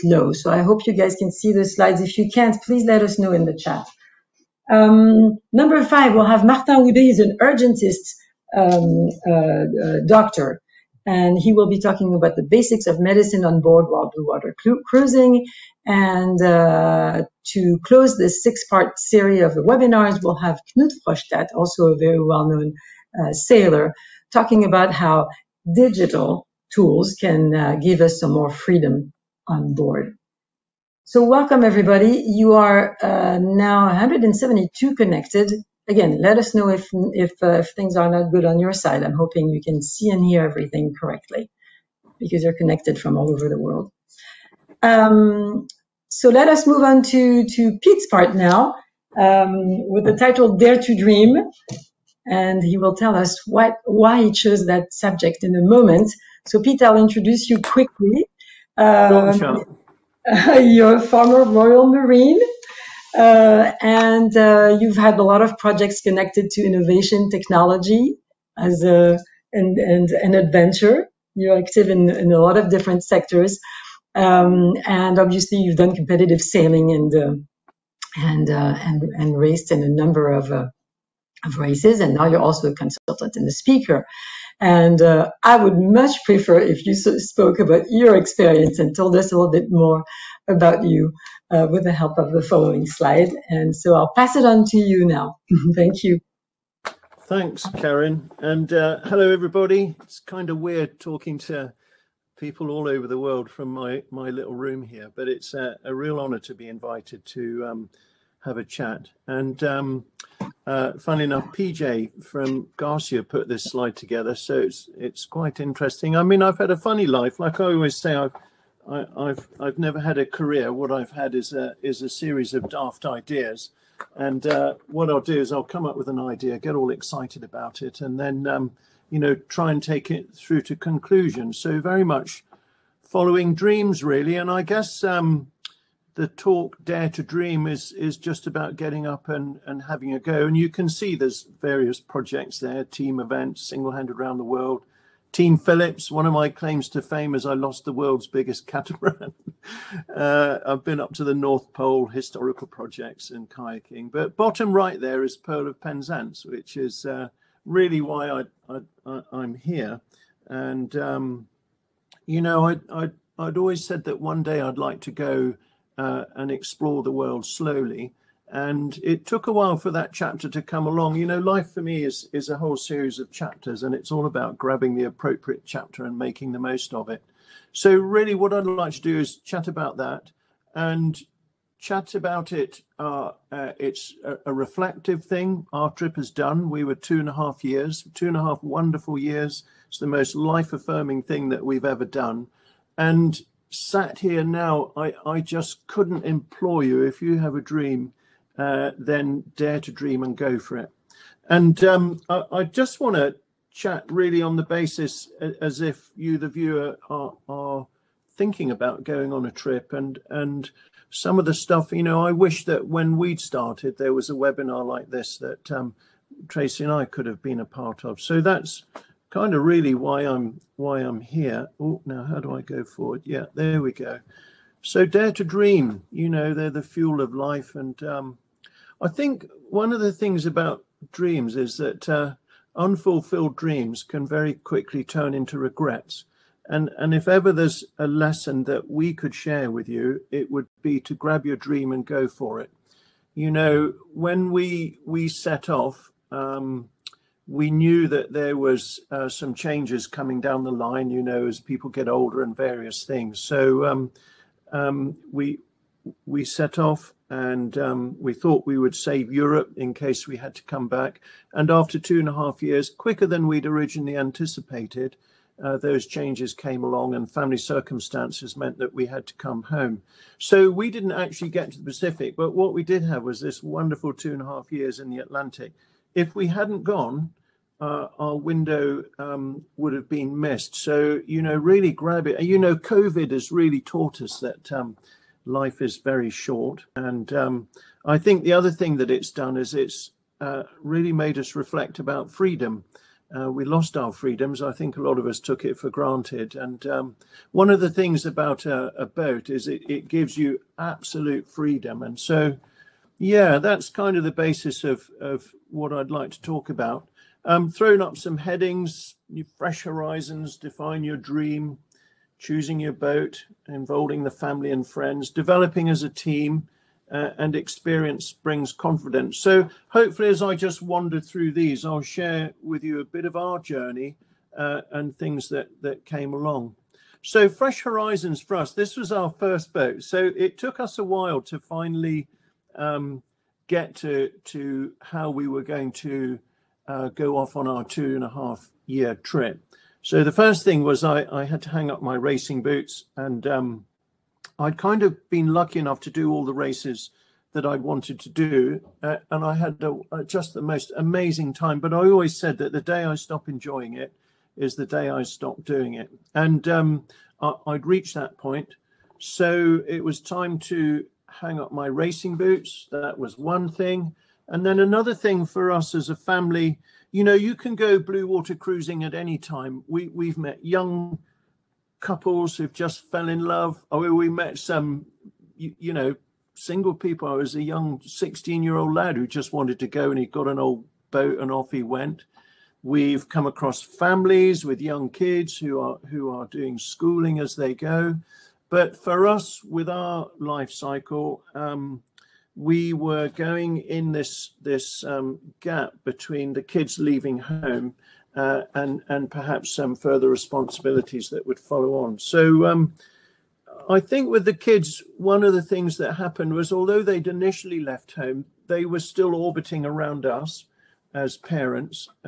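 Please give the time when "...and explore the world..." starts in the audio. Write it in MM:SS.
02:46.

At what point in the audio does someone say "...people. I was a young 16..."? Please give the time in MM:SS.
06:16.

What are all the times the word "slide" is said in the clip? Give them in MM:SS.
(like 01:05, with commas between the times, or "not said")
00:01, 01:32, 01:53.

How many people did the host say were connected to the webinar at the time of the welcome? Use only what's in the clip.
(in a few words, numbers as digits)
172.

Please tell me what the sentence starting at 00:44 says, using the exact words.
Um, so let us move on to, to Pete's part now um, with the title Dare to Dream.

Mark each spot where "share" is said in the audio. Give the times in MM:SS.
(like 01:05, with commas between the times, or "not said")
03:59, 05:22.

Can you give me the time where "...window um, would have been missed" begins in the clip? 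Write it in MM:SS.
04:38.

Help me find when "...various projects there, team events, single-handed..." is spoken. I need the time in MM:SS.
02:21.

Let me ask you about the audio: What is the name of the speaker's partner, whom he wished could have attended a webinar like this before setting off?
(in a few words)
Tracy.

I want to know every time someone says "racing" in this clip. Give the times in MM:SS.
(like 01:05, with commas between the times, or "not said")
05:42, 06:01.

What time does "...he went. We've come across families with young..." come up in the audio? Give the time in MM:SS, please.
06:21.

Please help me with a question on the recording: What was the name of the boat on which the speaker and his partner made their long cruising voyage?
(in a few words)
Pearl of Penzance.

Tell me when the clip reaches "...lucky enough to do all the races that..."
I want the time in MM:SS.
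05:45.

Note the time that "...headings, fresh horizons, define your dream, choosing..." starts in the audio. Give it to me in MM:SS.
05:08.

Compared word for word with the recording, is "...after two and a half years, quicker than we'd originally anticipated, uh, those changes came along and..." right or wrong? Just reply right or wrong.
right.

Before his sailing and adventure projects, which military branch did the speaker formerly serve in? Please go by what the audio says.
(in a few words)
Royal Marine.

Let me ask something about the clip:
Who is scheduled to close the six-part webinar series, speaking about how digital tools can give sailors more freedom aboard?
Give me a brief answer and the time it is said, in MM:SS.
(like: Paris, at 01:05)
Knut Frostad, at 00:20.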